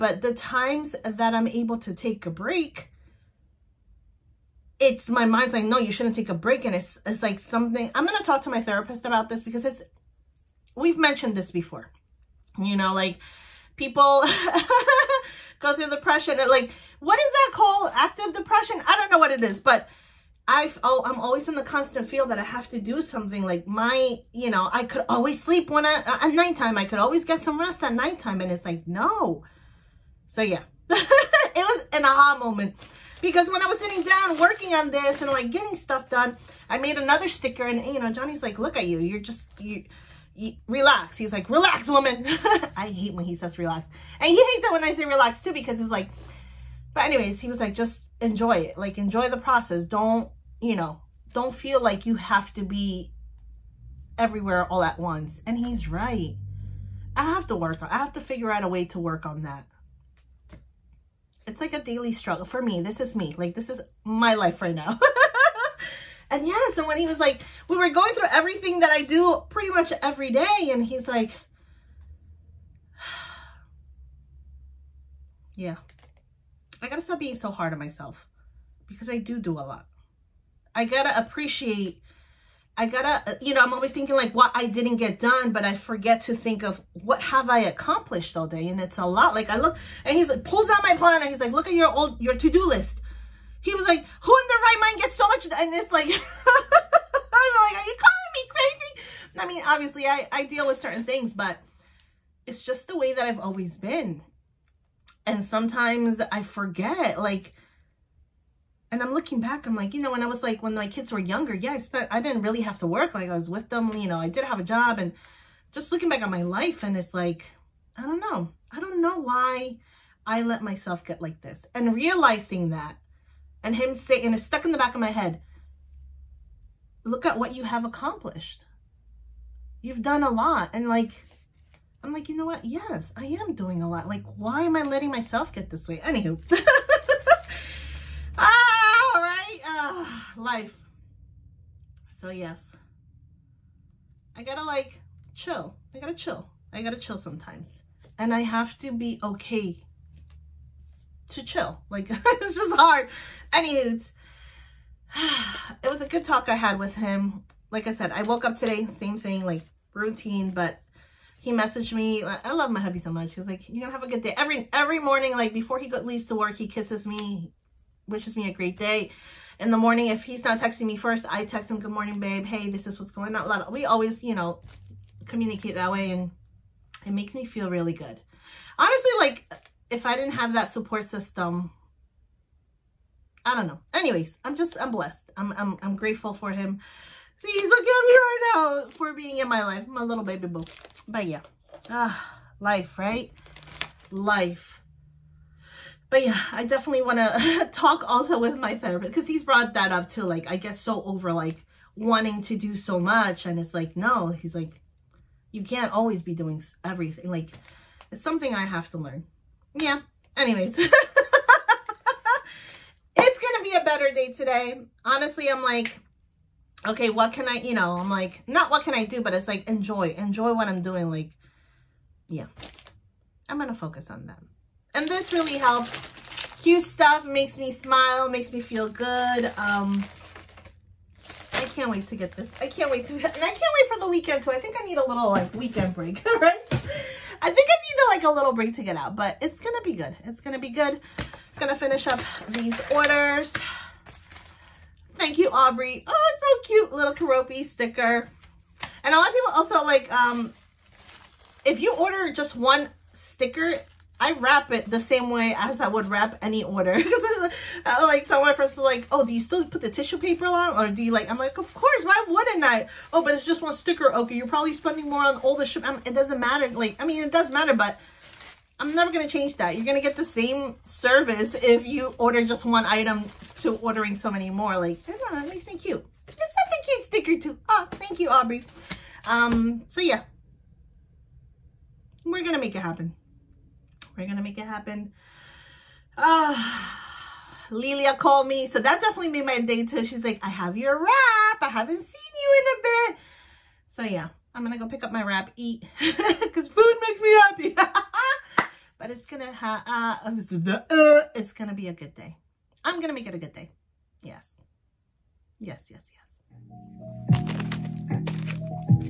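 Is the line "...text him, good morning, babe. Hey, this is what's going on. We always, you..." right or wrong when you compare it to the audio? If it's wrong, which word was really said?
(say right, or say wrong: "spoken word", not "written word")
right.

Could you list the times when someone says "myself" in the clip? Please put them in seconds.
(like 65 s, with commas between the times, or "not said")
77 s, 120 s, 135 s.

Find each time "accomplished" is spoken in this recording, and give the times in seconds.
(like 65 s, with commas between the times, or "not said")
87 s, 127 s.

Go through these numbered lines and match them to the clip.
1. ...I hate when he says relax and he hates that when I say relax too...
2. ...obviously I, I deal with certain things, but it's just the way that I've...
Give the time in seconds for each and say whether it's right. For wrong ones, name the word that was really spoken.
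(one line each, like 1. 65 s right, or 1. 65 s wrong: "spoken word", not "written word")
1. 42 s right
2. 99 s right.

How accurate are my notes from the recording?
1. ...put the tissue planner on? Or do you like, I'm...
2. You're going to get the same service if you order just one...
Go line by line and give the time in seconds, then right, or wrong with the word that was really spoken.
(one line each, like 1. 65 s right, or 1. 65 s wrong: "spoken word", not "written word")
1. 259 s wrong: "paper", not "planner"
2. 269 s right.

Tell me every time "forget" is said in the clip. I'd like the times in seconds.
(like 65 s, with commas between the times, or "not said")
85 s, 106 s.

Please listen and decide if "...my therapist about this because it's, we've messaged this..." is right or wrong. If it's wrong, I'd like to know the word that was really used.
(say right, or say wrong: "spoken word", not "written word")
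wrong: "mentioned", not "messaged".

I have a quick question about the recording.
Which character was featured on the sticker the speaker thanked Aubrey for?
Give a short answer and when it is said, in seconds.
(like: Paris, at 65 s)
Keroppi, at 247 s.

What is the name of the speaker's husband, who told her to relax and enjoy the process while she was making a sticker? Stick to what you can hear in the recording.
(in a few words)
Johnny.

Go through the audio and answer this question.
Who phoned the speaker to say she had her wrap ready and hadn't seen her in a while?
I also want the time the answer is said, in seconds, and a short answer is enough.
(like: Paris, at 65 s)
Lilia, at 287 s.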